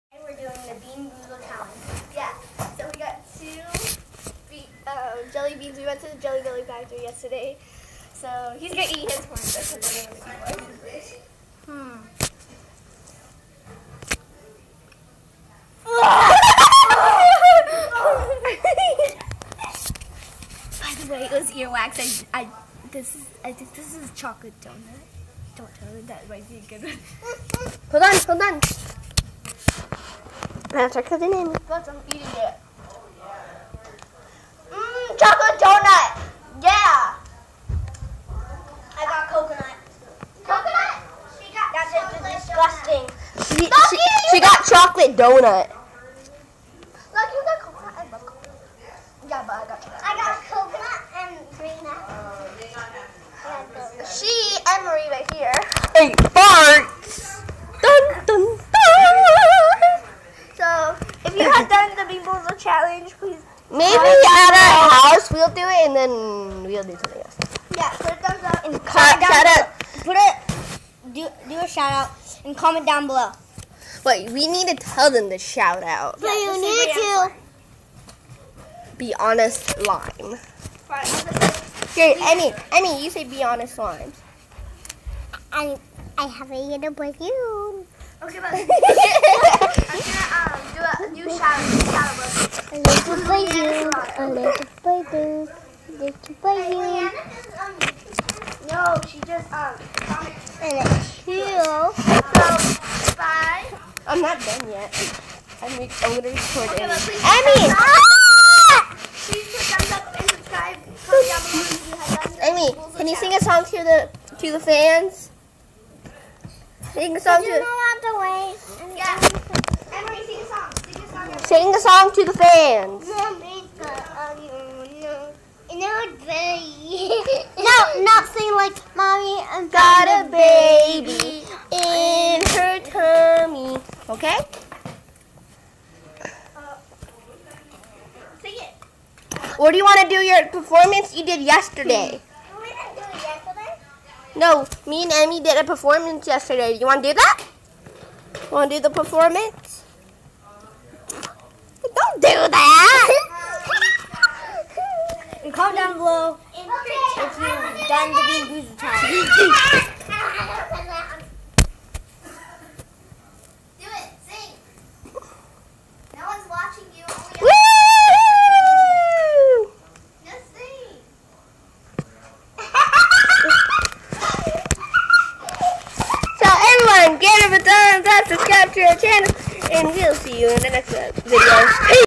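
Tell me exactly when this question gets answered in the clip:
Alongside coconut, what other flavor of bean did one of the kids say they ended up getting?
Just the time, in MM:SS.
00:51.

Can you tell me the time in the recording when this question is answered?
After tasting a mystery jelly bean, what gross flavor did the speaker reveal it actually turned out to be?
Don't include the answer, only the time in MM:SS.
00:21.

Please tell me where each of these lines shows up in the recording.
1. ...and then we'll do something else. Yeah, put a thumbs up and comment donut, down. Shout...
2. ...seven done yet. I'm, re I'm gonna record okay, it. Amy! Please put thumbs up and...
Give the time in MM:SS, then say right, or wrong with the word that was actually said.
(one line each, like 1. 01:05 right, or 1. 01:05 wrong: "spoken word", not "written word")
1. 01:05 wrong: "shout", not "donut"
2. 01:41 wrong: "two", not "seven".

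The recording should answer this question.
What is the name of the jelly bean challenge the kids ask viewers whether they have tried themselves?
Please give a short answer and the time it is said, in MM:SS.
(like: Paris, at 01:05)
Beanboozle challenge, at 01:02.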